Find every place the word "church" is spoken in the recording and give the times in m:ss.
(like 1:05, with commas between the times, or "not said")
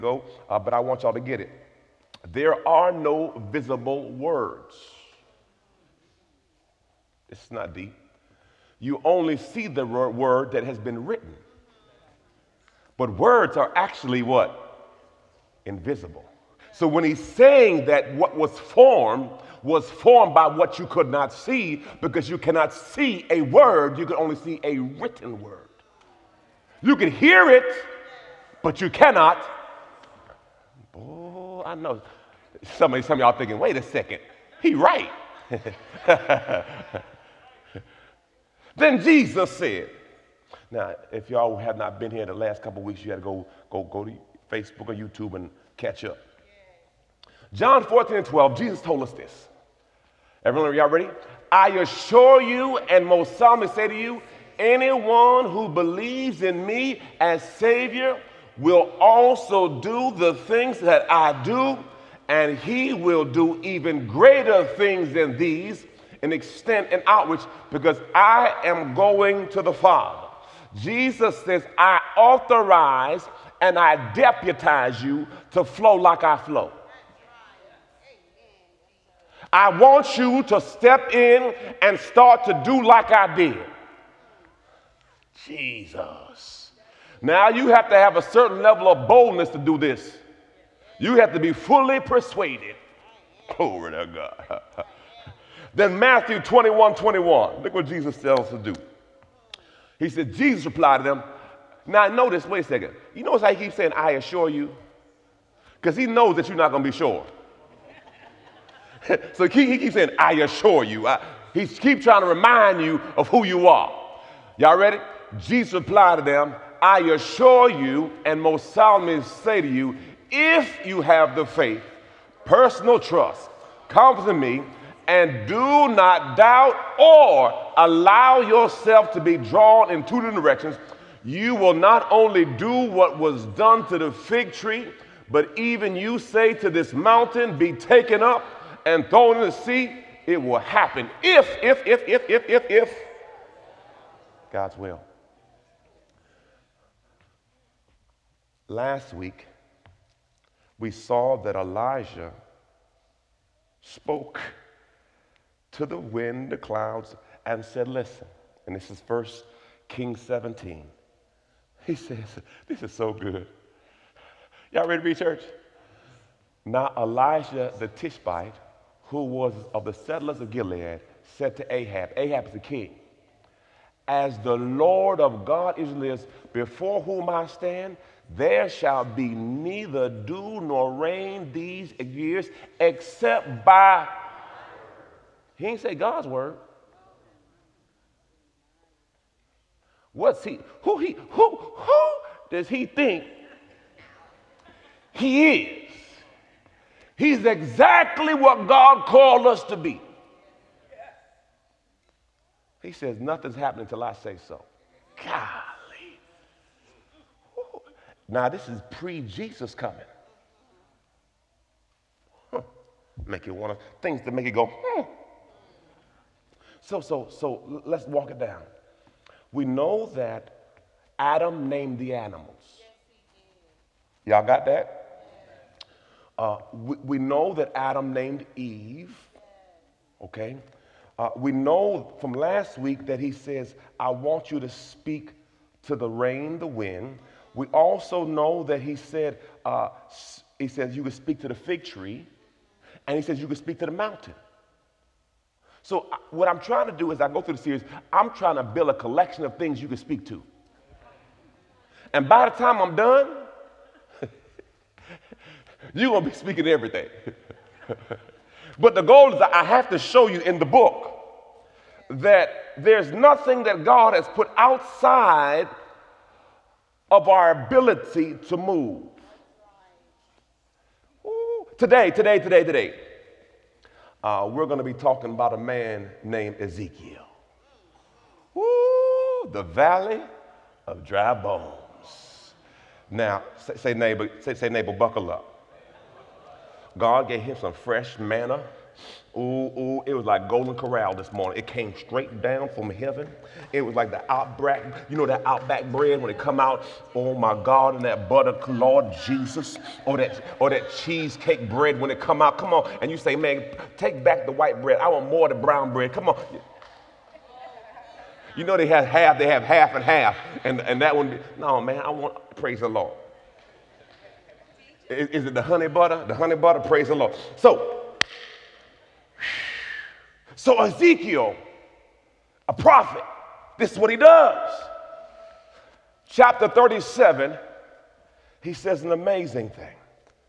2:45.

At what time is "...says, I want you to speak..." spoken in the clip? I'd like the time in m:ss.
3:53.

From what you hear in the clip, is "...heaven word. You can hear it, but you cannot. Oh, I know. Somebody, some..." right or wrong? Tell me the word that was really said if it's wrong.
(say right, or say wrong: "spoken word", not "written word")
wrong: "written", not "heaven".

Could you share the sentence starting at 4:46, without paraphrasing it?
God gave him some fresh manna Ooh, ooh, it was like Golden Corral this morning.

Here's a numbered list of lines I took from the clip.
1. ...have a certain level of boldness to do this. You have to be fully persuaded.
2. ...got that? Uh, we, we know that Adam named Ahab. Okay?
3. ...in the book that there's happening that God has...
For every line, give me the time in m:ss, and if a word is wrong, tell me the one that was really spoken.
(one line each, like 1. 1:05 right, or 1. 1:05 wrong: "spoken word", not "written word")
1. 1:27 right
2. 3:44 wrong: "Eve", not "Ahab"
3. 4:20 wrong: "nothing", not "happening".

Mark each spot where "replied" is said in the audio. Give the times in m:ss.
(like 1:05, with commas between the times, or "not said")
1:40, 1:55.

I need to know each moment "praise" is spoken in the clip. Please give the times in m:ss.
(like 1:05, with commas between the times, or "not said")
5:12, 5:16.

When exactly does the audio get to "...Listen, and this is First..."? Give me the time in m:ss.
2:37.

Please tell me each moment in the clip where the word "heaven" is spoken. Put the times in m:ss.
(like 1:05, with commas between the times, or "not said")
4:52.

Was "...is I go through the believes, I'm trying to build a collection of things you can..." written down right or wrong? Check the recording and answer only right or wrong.
wrong.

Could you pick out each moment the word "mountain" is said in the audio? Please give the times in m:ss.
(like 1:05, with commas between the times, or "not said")
2:16, 4:03.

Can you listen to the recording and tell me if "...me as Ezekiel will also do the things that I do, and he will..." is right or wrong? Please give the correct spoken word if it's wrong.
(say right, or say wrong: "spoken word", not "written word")
wrong: "Savior", not "Ezekiel".